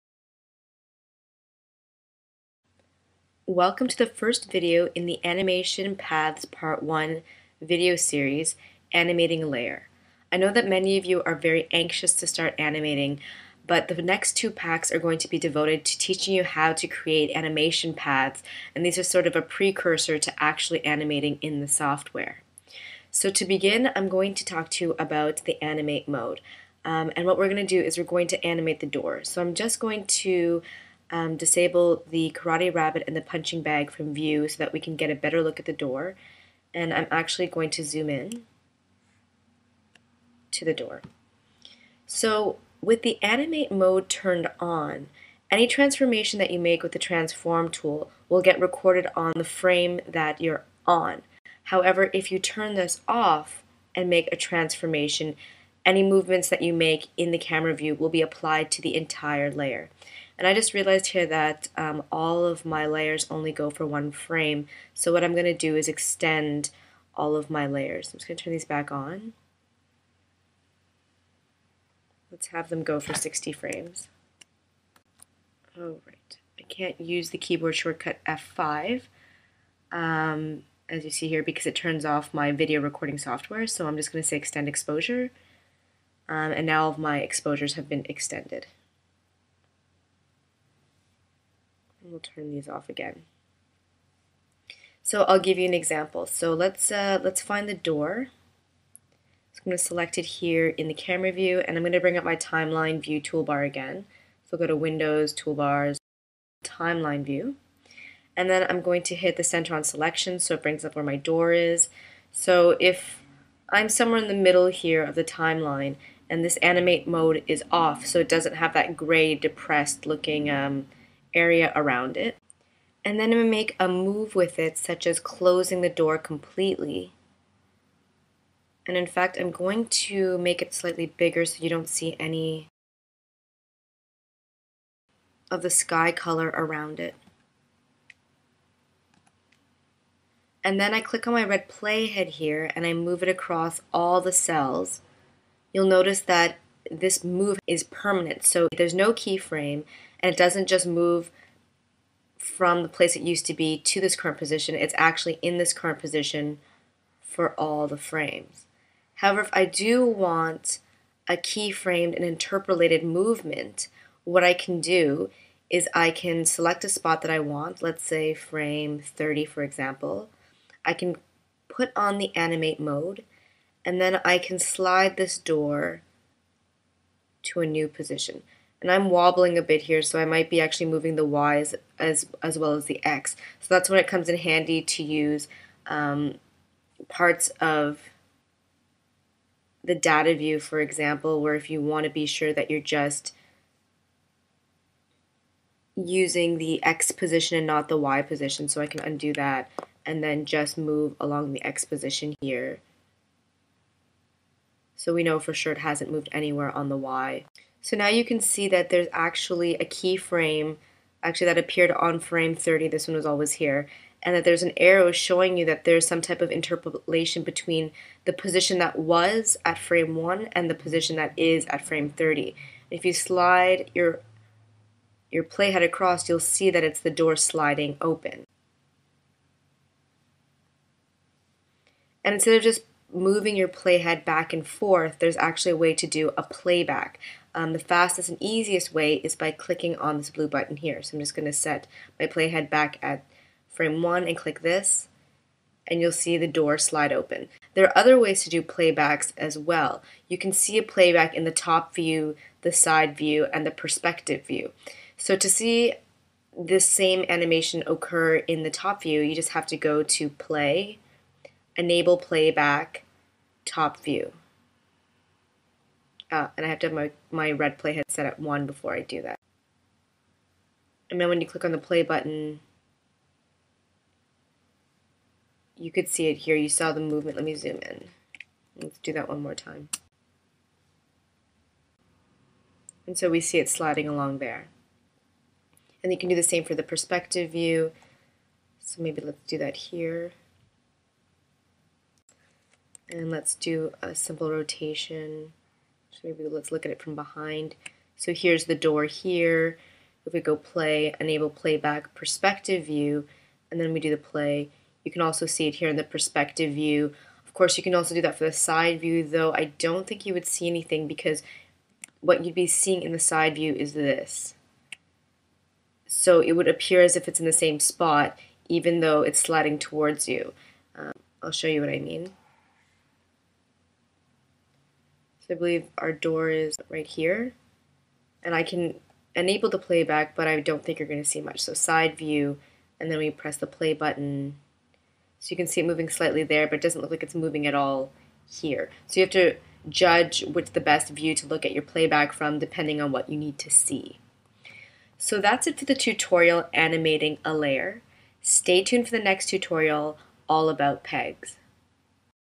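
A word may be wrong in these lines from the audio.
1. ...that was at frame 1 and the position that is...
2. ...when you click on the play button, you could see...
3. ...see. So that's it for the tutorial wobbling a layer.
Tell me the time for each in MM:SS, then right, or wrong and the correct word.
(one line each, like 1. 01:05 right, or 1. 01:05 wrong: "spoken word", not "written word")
1. 03:38 right
2. 04:31 right
3. 05:43 wrong: "animating", not "wobbling".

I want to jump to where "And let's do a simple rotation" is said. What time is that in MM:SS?
04:53.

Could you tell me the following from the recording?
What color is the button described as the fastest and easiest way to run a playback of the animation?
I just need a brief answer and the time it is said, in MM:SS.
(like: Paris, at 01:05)
Blue, at 04:00.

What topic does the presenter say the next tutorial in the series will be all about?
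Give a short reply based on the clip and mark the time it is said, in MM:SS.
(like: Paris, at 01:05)
Pegs, at 05:51.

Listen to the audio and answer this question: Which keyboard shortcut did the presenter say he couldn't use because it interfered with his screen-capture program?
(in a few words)
F5.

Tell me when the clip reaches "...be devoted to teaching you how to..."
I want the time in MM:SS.
00:15.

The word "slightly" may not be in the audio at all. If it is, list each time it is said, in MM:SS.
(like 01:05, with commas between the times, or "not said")
02:10, 05:36.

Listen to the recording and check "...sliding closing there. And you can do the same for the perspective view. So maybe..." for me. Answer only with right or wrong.
wrong.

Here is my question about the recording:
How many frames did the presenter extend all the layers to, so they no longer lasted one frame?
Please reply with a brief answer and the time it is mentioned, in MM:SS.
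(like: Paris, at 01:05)
60, at 01:13.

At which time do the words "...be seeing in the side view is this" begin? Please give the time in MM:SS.
05:12.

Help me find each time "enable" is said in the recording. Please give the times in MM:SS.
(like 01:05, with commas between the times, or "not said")
04:21, 05:01, 05:29.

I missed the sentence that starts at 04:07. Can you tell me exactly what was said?
There are other ways to do playbacks as well.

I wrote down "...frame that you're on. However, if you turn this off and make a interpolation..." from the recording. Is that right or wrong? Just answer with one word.
wrong.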